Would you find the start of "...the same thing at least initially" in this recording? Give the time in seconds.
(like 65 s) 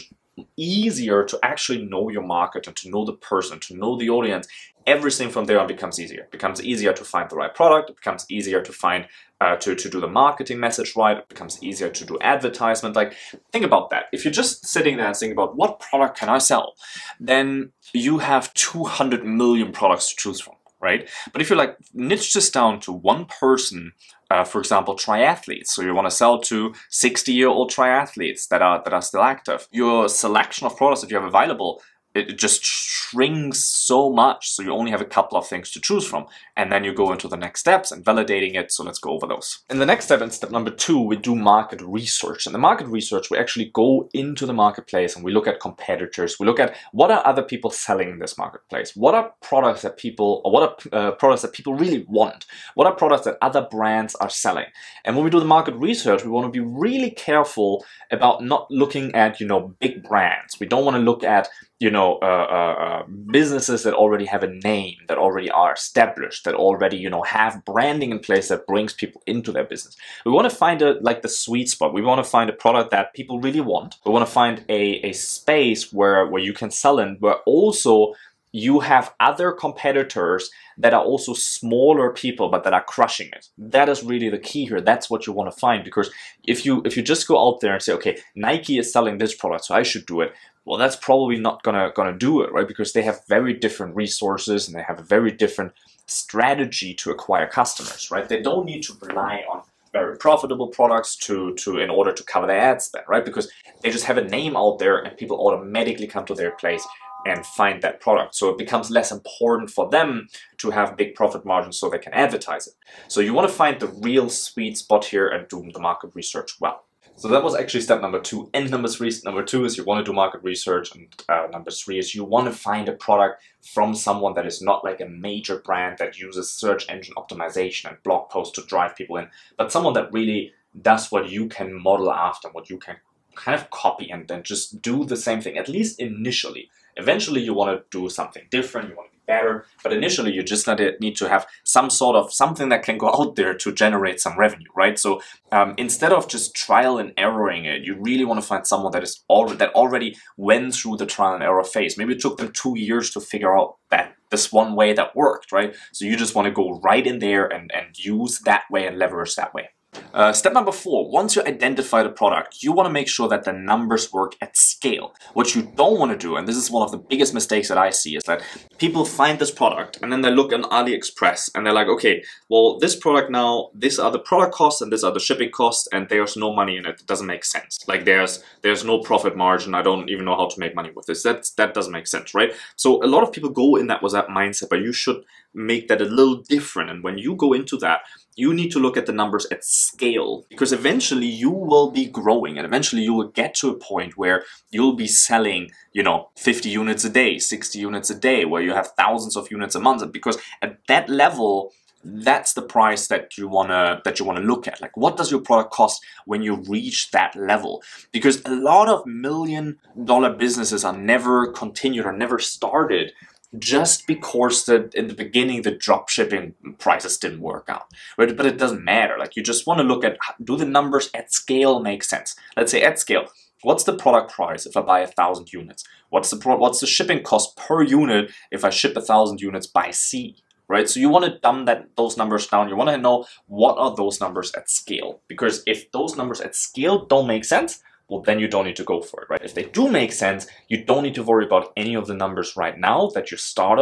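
135 s.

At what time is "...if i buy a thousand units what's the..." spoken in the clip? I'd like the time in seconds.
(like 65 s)
224 s.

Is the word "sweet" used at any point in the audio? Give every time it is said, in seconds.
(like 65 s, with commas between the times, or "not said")
71 s, 114 s.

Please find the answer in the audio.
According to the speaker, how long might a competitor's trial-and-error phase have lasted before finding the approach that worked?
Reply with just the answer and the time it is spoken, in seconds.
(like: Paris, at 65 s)
2 years, at 152 s.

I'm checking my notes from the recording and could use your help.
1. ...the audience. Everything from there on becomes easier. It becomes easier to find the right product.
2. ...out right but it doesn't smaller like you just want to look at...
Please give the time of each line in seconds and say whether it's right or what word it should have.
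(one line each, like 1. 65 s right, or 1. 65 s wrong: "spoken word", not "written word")
1. 3 s right
2. 217 s wrong: "matter", not "smaller".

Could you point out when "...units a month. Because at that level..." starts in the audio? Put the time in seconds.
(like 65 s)
199 s.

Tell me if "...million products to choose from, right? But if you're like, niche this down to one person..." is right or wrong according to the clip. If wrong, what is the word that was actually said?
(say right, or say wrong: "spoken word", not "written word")
right.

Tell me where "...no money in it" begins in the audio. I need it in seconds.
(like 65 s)
176 s.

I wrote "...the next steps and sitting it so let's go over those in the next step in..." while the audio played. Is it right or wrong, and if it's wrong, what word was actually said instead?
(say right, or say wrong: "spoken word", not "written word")
wrong: "validating", not "sitting".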